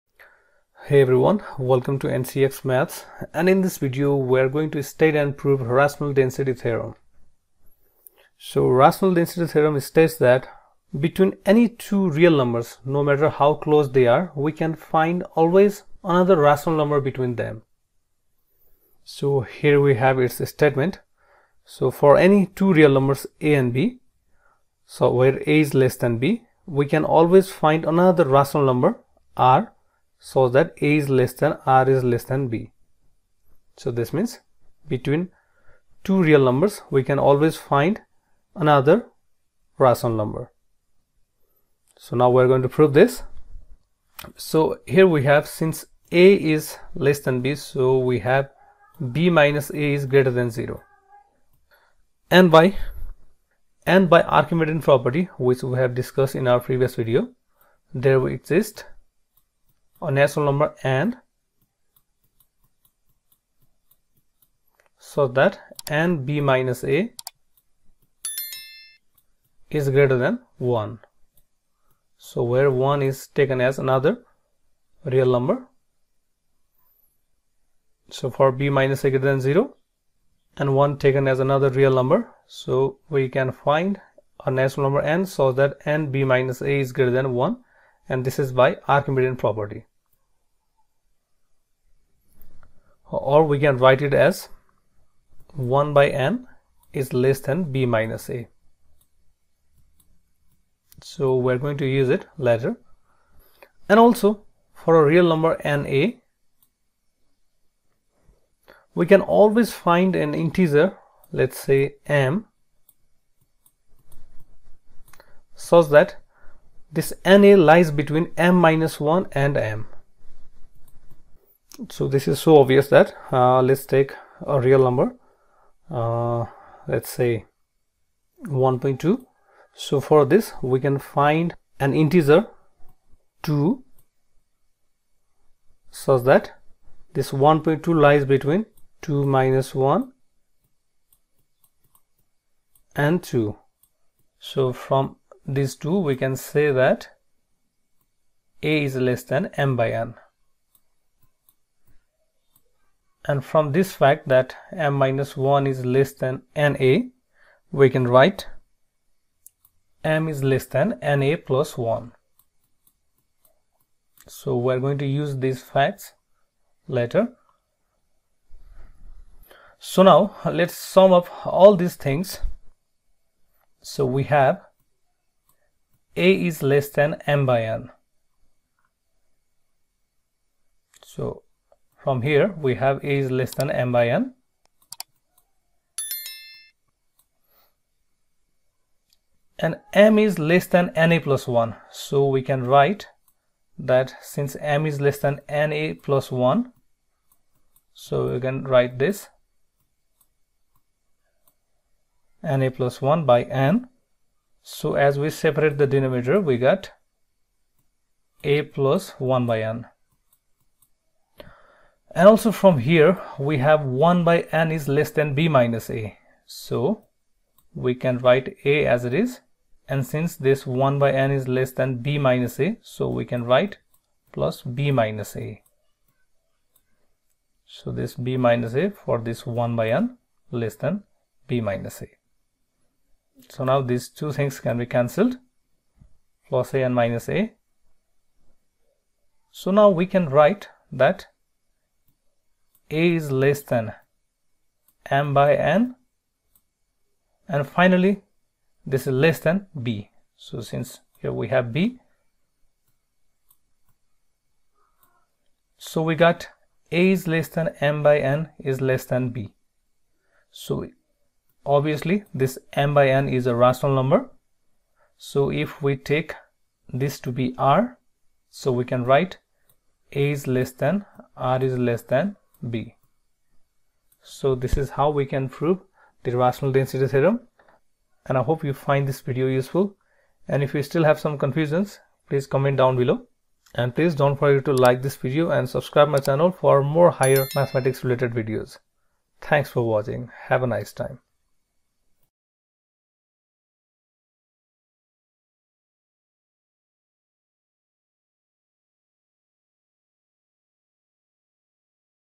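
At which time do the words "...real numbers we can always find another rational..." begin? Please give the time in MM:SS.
00:36.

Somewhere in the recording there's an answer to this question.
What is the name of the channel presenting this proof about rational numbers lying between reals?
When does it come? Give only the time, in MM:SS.
00:02.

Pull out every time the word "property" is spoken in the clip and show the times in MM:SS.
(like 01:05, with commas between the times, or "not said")
00:54, 01:29.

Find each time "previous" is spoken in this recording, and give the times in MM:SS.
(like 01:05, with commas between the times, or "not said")
00:56.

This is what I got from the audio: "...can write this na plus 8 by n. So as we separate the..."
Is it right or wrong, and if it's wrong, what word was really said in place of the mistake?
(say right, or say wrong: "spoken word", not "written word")
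wrong: "1", not "8".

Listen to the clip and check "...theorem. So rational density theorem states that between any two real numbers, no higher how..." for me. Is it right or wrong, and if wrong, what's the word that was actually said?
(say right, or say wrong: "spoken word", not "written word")
wrong: "matter", not "higher".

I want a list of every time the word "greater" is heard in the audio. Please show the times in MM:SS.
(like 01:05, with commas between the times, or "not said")
00:50, 01:09, 01:19, 01:26.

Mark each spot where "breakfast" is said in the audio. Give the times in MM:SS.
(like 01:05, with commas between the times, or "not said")
not said.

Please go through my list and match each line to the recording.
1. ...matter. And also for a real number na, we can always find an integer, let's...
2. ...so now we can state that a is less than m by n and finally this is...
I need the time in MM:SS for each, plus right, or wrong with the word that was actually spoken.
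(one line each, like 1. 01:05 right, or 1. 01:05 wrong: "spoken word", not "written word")
1. 01:42 wrong: "later", not "matter"
2. 03:59 wrong: "write", not "state".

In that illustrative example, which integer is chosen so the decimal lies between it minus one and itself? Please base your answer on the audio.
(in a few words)
2.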